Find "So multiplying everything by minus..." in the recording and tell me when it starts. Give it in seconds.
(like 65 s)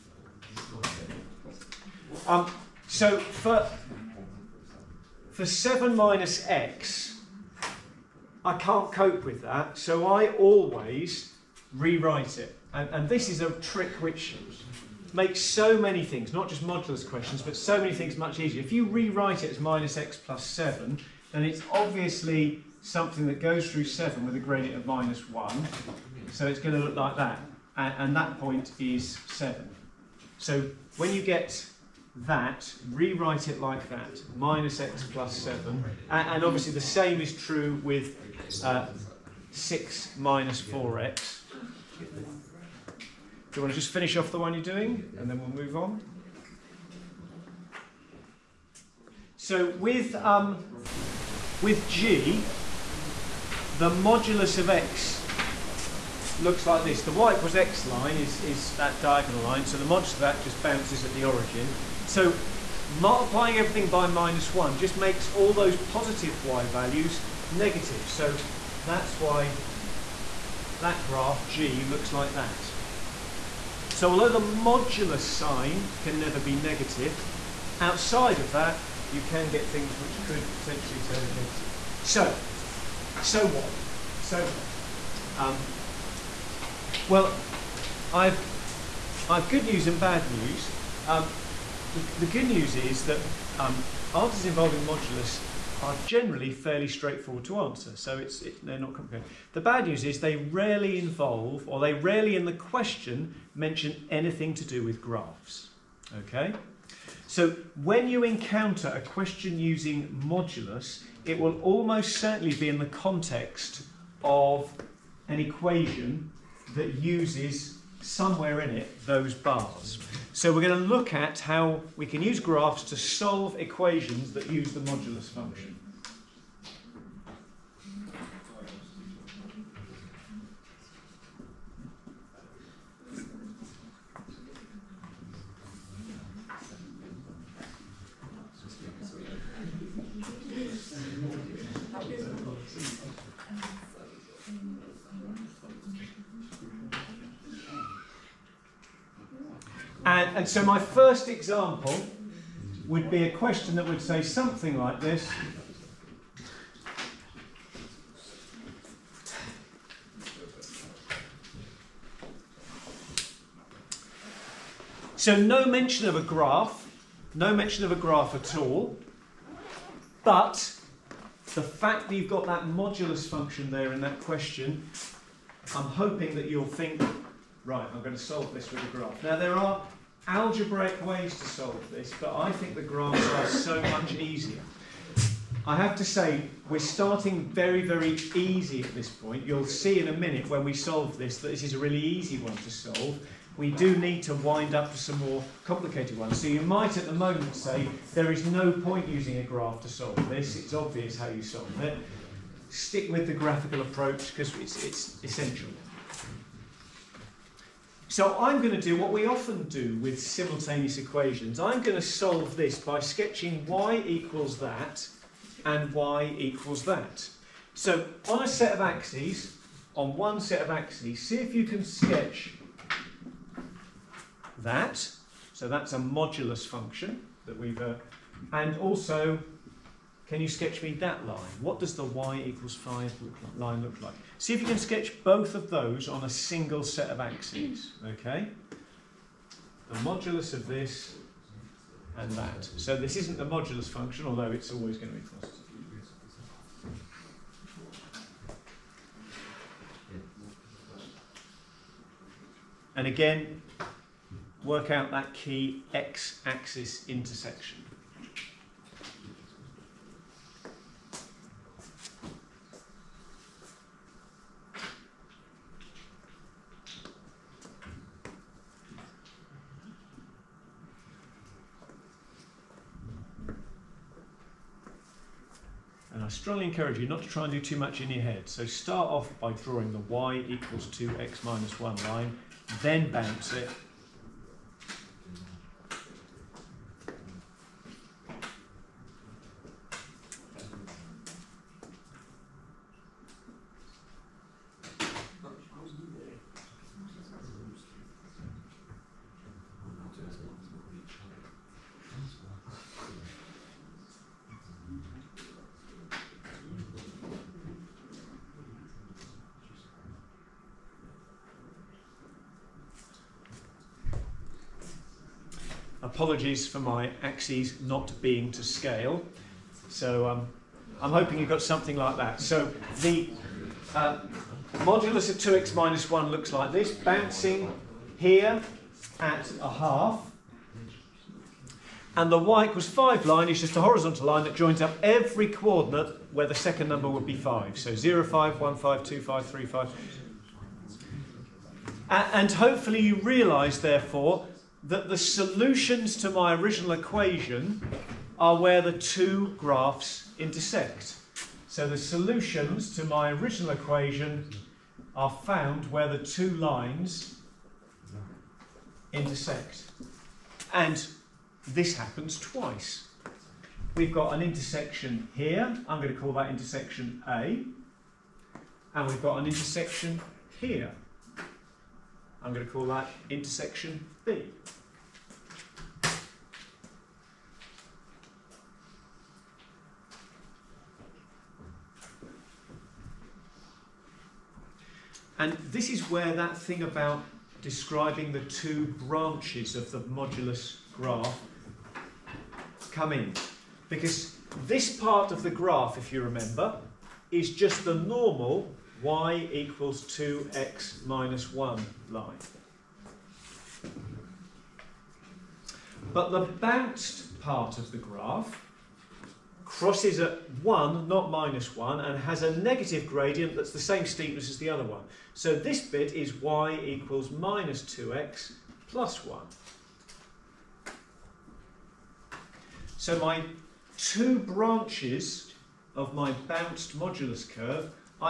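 62 s.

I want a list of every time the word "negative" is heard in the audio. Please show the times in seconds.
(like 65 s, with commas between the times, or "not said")
67 s, 76 s, 81 s, 412 s.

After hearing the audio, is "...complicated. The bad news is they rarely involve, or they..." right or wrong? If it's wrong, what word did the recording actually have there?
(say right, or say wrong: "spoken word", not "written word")
right.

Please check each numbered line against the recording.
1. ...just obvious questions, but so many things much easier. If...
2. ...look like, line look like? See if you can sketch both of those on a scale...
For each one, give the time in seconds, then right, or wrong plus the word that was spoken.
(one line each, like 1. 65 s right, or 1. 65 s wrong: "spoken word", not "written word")
1. 16 s wrong: "modulus", not "obvious"
2. 233 s wrong: "single", not "scale".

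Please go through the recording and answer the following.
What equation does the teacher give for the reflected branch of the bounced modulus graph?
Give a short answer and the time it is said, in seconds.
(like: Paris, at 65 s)
y = -2x + 1, at 416 s.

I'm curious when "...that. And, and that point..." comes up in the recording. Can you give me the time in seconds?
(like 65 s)
27 s.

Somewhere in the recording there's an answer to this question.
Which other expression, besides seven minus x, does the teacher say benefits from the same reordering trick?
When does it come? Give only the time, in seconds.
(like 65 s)
39 s.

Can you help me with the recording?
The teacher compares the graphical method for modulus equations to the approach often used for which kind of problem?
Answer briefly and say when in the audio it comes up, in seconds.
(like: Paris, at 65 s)
simultaneous equations, at 210 s.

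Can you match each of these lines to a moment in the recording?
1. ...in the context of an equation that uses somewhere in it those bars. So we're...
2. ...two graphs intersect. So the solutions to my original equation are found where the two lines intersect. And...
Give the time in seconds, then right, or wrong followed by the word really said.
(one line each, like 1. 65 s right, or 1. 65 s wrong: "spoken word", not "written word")
1. 112 s right
2. 348 s right.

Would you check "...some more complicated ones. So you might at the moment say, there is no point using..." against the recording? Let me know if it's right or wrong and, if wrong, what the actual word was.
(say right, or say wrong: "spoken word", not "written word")
right.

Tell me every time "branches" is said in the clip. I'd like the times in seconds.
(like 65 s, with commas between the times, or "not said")
389 s, 424 s.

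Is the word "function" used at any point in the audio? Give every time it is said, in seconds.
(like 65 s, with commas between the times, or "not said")
125 s, 173 s, 226 s, 243 s.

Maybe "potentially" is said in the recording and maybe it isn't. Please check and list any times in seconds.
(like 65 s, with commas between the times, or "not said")
80 s.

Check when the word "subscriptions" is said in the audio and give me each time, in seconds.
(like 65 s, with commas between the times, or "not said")
not said.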